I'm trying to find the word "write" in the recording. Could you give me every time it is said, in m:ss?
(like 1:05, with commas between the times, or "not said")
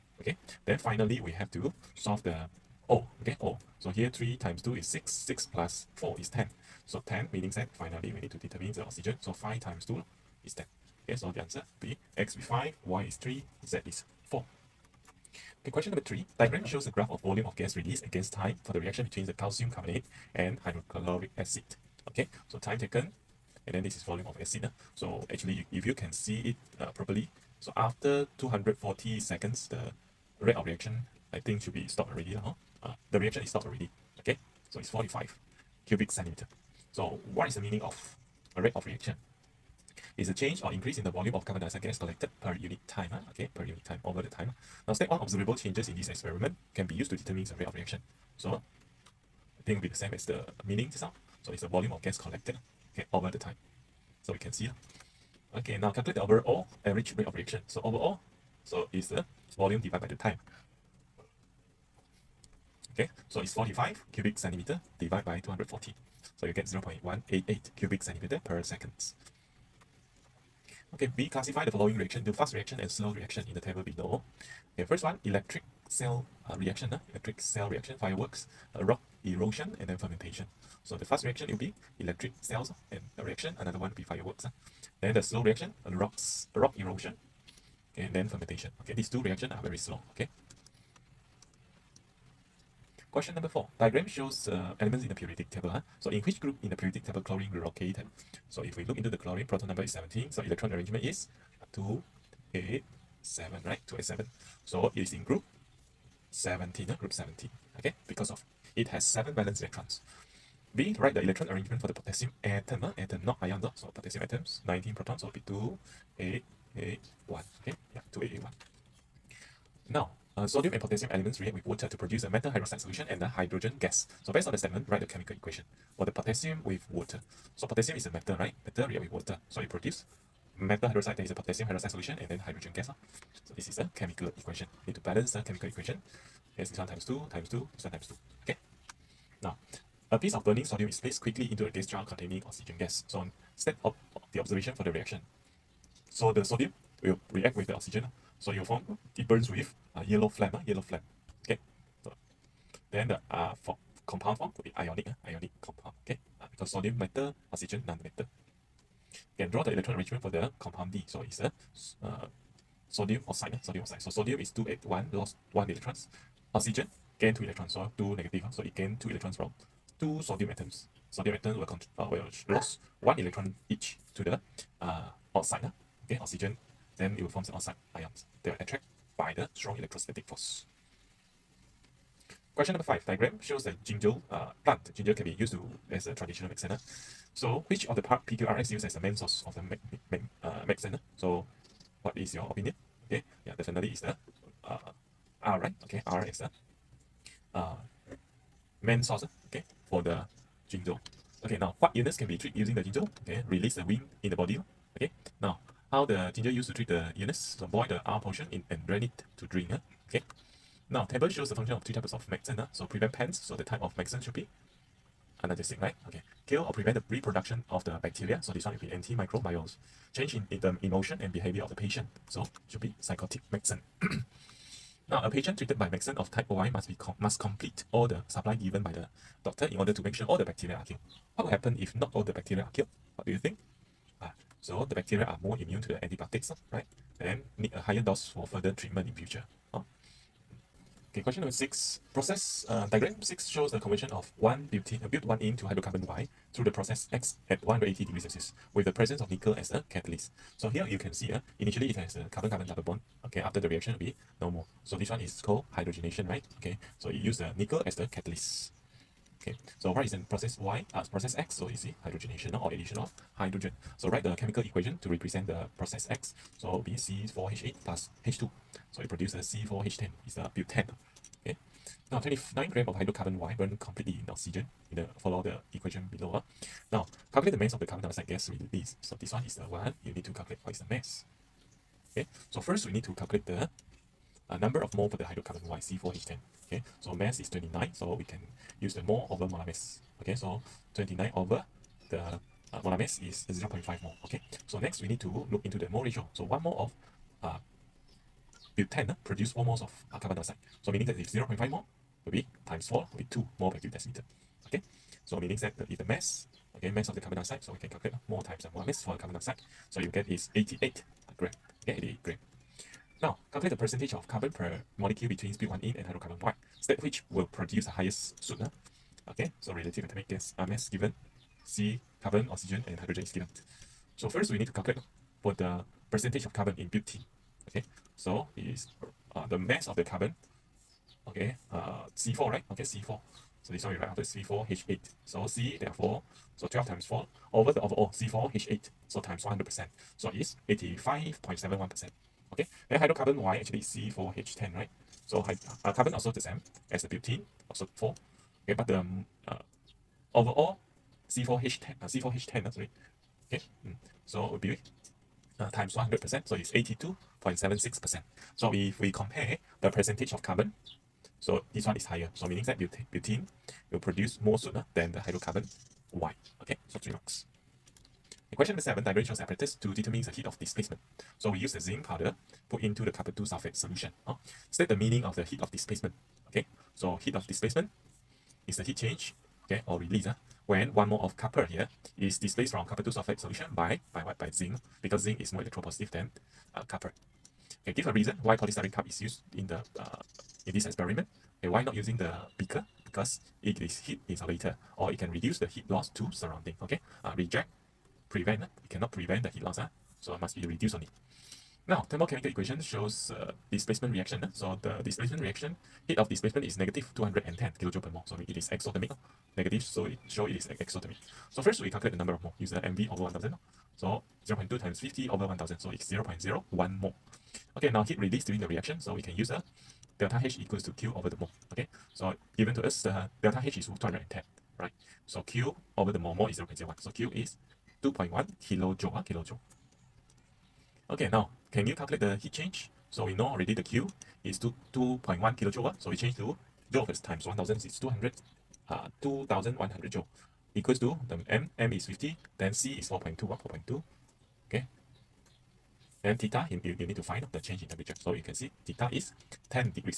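1:50, 2:04, 4:24, 5:33.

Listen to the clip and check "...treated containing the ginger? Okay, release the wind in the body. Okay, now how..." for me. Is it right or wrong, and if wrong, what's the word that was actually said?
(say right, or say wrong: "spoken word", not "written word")
wrong: "using", not "containing".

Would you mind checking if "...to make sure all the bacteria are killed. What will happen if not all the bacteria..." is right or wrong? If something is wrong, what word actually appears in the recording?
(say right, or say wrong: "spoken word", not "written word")
right.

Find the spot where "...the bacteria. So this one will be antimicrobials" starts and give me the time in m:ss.
3:37.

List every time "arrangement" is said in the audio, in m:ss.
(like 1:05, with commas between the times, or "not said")
1:40, 1:51, 2:39.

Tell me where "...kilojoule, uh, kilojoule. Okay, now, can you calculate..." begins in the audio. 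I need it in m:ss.
7:08.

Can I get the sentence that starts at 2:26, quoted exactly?
So the sodium will react with the oxygen.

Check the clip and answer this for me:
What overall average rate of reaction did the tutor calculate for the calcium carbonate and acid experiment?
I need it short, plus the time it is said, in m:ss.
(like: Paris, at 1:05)
0.188 cubic centimeter per second, at 1:06.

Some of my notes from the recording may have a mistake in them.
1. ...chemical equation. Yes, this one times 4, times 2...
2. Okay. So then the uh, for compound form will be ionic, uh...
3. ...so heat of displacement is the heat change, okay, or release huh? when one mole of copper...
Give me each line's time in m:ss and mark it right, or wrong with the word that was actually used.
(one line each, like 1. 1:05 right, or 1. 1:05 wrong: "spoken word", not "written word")
1. 2:15 wrong: "2", not "4"
2. 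2:31 right
3. 6:16 right.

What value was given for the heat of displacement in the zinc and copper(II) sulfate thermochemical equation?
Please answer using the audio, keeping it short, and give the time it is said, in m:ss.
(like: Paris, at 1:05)
-210 kJ/mol, at 6:46.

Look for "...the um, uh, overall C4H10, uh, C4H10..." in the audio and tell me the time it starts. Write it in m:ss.
5:48.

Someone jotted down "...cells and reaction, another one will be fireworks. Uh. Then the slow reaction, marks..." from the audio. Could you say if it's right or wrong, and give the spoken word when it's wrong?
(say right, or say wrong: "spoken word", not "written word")
wrong: "rocks", not "marks".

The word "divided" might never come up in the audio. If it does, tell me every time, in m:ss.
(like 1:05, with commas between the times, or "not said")
0:59, 1:04.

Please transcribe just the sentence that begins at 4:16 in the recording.
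Okay, so you use the nickel as the catalyst.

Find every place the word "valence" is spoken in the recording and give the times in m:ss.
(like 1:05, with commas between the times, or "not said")
1:49.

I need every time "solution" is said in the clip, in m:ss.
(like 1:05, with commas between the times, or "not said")
2:02, 2:11, 6:13, 6:23.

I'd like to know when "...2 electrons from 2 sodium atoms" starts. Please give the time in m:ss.
2:48.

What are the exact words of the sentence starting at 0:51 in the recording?
So it's the volume of gas collected okay, over the time.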